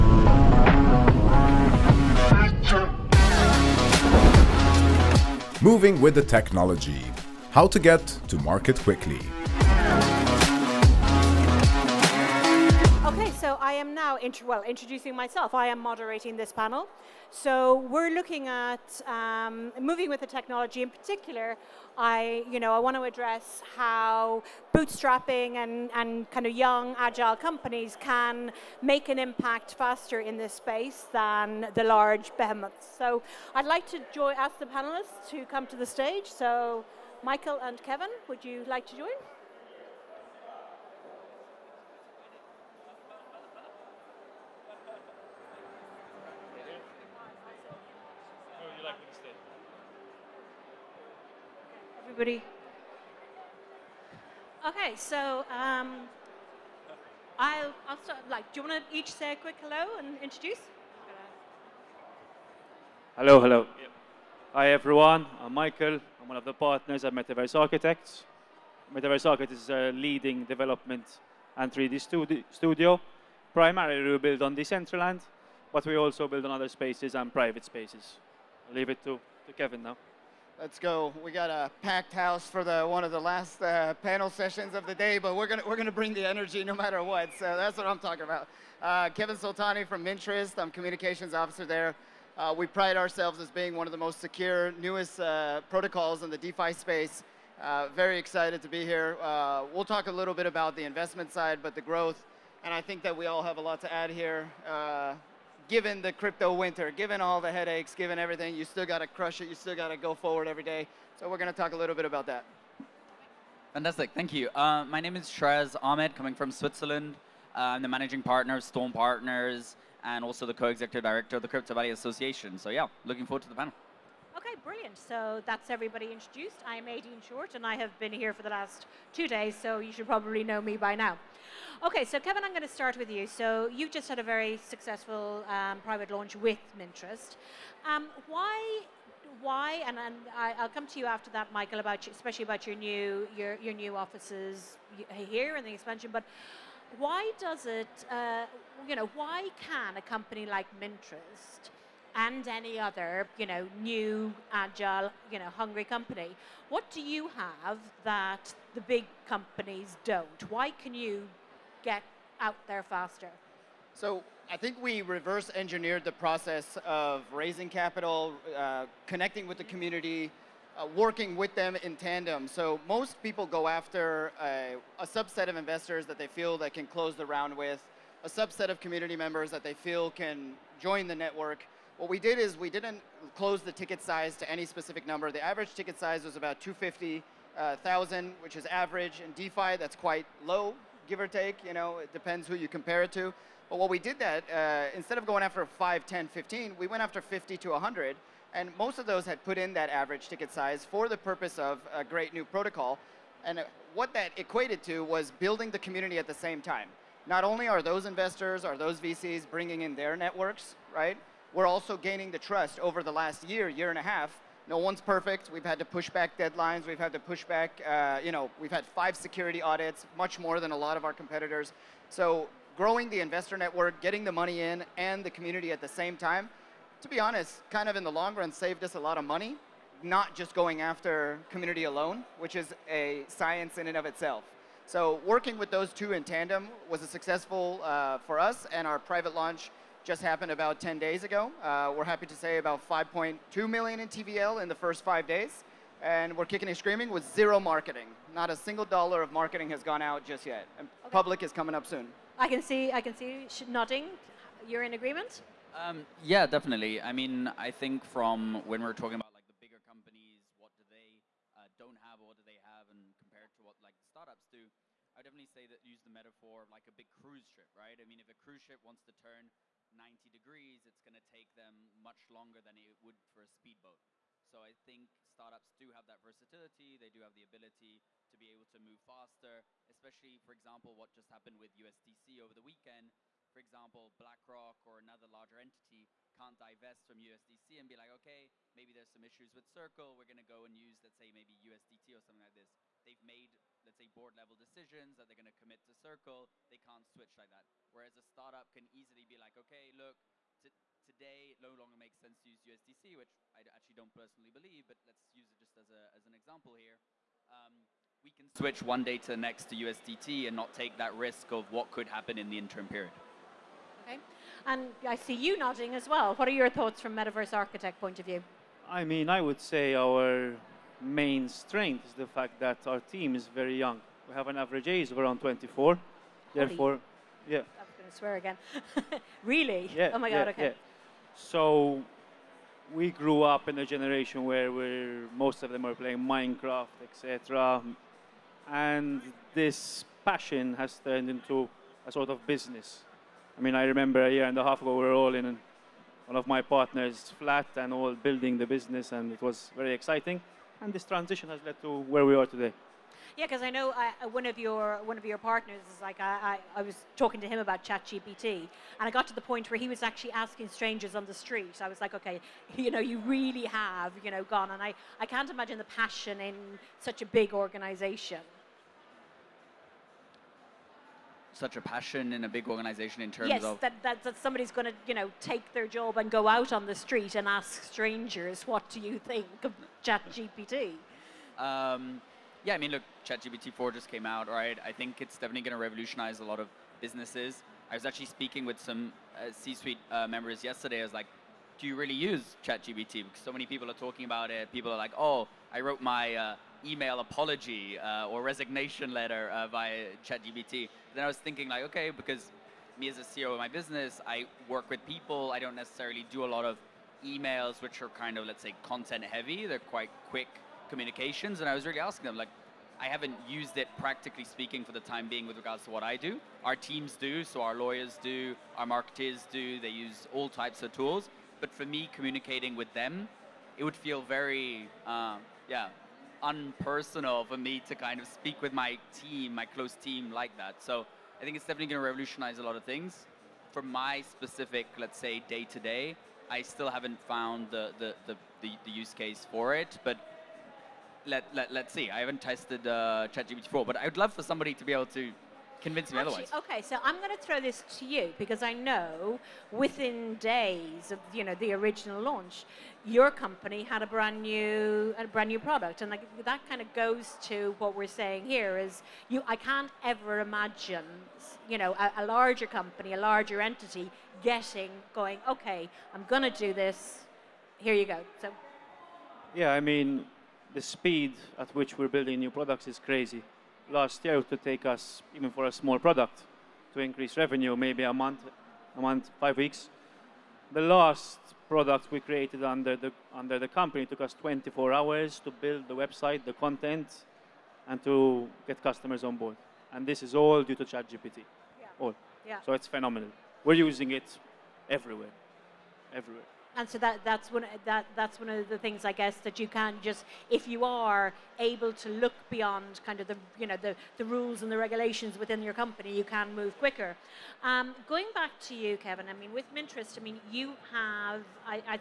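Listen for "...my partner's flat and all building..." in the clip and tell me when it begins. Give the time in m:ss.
5:46.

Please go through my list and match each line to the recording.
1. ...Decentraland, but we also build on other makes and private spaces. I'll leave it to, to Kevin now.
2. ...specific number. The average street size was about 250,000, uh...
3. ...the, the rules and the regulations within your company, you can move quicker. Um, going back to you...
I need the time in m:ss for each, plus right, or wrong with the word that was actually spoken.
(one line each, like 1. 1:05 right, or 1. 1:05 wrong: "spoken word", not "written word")
1. 1:14 wrong: "spaces", not "makes"
2. 3:04 wrong: "ticket", not "street"
3. 8:23 right.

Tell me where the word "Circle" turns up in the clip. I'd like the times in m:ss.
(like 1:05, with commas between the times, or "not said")
4:49, 4:55.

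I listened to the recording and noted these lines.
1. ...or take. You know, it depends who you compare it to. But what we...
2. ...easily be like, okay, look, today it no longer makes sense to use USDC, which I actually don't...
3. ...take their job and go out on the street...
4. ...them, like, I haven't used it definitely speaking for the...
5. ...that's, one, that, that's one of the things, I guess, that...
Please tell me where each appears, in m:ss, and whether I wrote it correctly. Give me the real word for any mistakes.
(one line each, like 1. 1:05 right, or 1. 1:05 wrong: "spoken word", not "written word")
1. 3:11 right
2. 4:58 right
3. 6:15 right
4. 6:52 wrong: "practically", not "definitely"
5. 8:17 right.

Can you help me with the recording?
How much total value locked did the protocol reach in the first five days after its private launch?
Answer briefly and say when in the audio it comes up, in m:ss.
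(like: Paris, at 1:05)
5.2 million, at 4:02.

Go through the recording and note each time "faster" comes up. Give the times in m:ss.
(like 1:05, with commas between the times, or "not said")
0:29, 2:42, 4:39.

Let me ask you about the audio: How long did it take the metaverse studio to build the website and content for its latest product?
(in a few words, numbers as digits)
24 hours.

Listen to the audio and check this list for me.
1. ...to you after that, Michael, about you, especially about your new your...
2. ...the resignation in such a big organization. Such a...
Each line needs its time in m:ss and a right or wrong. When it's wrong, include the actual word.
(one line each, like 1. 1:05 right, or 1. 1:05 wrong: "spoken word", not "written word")
1. 2:20 right
2. 6:05 wrong: "passion", not "resignation".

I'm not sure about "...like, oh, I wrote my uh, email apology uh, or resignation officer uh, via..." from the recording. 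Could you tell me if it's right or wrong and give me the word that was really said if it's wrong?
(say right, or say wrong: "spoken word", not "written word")
wrong: "letter", not "officer".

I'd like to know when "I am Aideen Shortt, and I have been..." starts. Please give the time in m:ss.
2:06.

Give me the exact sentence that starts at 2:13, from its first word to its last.
So you've just had a very successful um, private launch with Mintrust.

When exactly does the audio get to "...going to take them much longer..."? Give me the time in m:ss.
4:31.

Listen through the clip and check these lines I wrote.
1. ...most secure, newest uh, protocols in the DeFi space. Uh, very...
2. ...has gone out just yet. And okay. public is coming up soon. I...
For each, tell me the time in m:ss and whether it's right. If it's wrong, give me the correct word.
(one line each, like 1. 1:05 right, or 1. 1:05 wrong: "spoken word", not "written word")
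1. 1:33 right
2. 4:09 right.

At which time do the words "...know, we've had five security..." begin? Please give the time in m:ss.
3:38.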